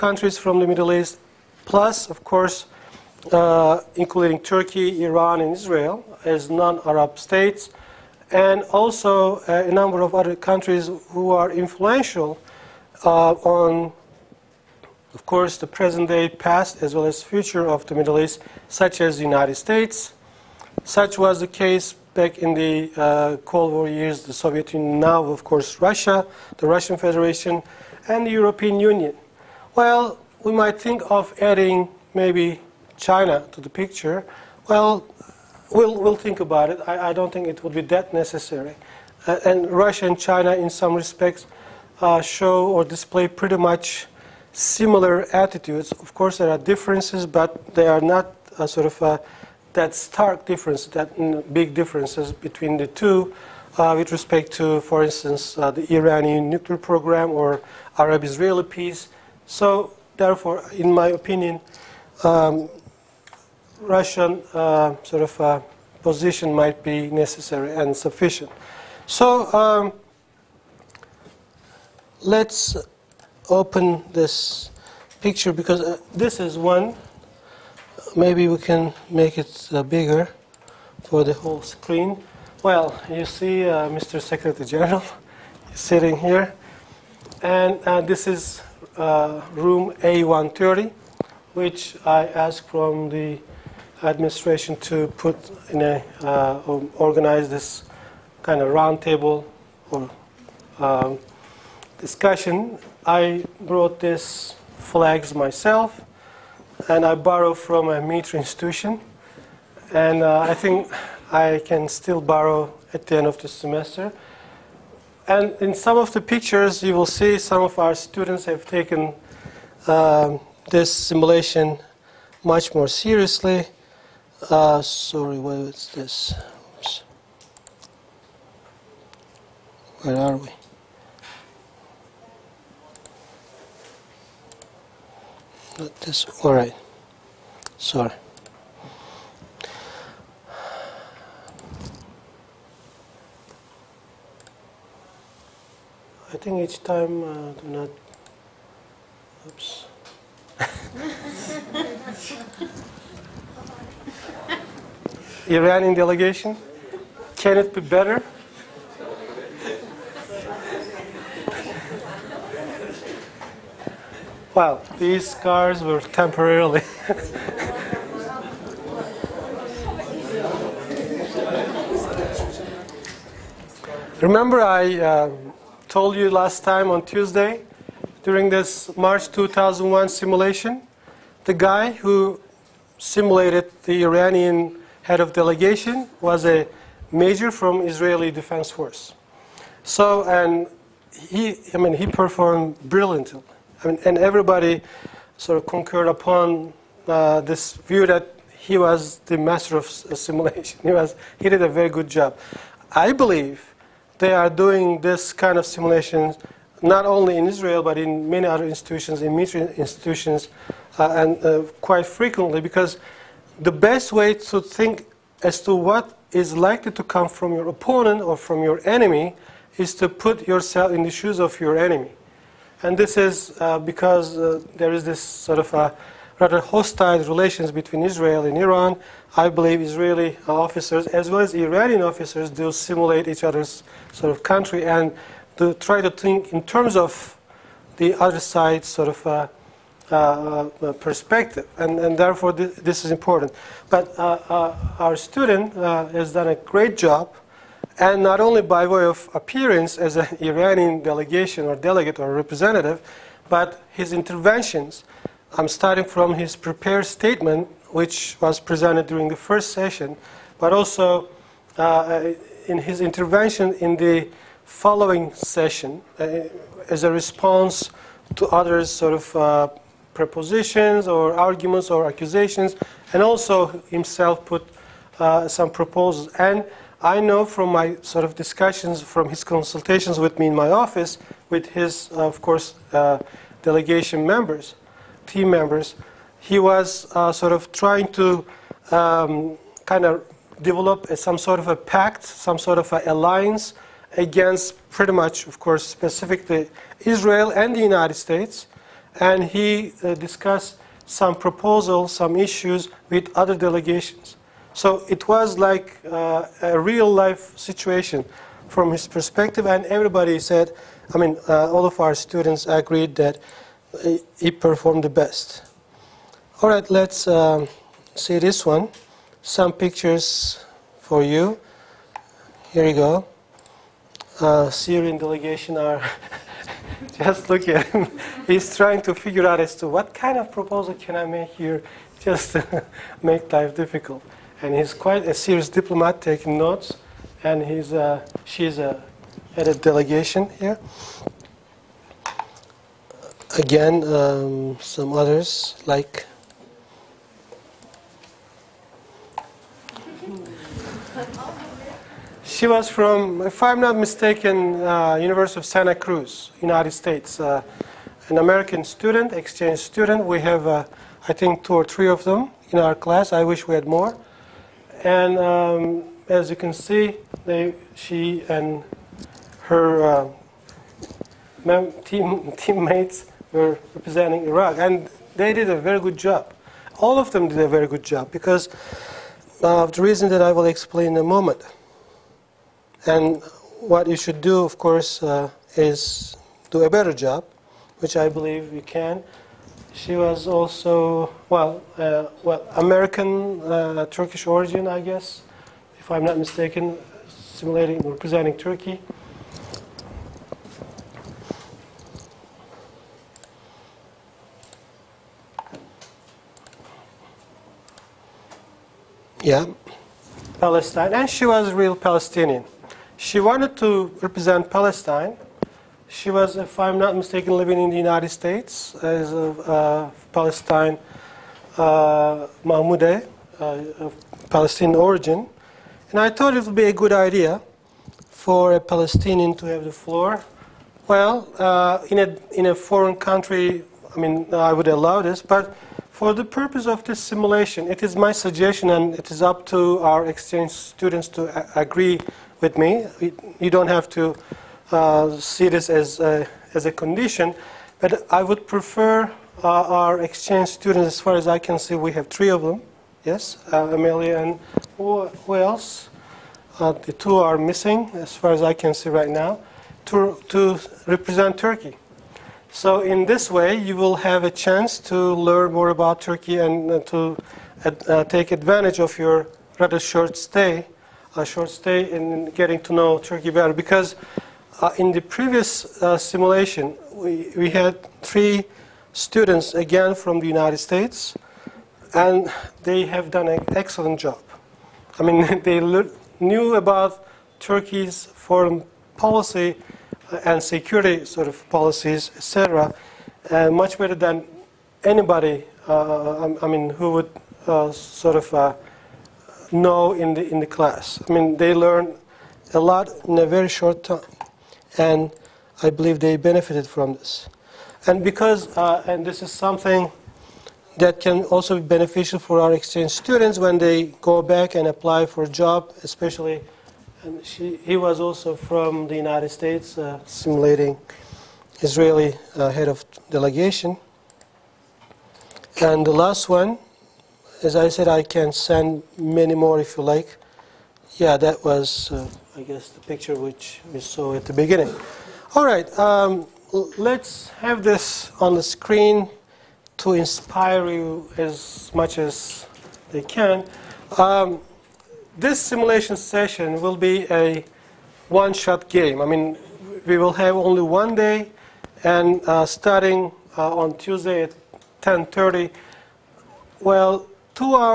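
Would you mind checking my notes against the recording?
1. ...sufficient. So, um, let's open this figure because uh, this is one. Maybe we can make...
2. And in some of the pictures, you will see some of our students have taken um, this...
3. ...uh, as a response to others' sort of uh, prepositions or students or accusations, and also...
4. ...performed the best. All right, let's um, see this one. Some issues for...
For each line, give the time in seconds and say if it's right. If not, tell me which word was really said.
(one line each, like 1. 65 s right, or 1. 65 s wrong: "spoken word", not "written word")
1. 67 s wrong: "picture", not "figure"
2. 115 s right
3. 266 s wrong: "arguments", not "students"
4. 314 s wrong: "pictures", not "issues".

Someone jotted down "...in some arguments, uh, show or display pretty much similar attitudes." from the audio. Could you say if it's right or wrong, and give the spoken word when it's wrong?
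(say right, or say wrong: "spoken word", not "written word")
wrong: "respects", not "arguments".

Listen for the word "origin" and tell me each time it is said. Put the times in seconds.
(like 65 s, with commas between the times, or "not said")
394 s, 424 s.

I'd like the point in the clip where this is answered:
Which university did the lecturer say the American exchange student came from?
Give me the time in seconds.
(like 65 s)
355 s.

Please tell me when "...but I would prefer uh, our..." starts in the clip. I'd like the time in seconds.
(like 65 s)
447 s.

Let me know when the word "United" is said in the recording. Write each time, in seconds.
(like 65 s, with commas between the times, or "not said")
19 s, 297 s, 356 s, 417 s, 480 s, 519 s.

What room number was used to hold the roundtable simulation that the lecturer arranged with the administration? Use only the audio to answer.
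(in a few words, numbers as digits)
A130.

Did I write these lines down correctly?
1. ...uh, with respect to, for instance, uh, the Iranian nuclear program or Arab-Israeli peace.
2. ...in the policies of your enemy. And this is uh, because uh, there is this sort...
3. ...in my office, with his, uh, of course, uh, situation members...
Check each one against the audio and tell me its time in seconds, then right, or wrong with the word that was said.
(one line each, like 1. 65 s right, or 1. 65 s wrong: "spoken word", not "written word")
1. 53 s right
2. 220 s wrong: "shoes", not "policies"
3. 280 s wrong: "delegation", not "situation".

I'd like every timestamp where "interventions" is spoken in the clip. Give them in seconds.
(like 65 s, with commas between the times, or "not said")
254 s, 262 s.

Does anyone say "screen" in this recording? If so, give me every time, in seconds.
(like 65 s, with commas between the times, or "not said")
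81 s, 538 s.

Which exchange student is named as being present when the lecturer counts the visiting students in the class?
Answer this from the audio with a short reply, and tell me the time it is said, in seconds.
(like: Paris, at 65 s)
Amelia, at 453 s.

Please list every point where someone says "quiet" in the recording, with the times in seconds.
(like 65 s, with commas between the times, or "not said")
not said.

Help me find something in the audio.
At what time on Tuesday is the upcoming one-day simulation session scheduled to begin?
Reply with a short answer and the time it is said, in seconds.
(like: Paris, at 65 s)
10:30, at 555 s.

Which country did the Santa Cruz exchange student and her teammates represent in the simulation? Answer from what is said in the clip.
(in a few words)
Iraq.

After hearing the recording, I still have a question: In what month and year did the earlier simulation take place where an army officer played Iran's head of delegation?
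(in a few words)
March 2001.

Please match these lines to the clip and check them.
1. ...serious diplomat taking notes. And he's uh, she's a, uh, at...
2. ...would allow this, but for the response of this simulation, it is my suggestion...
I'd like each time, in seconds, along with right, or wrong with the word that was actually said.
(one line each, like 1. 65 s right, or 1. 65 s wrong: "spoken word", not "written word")
1. 335 s right
2. 434 s wrong: "purpose", not "response".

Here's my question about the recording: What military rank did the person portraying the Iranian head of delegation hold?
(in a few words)
Major.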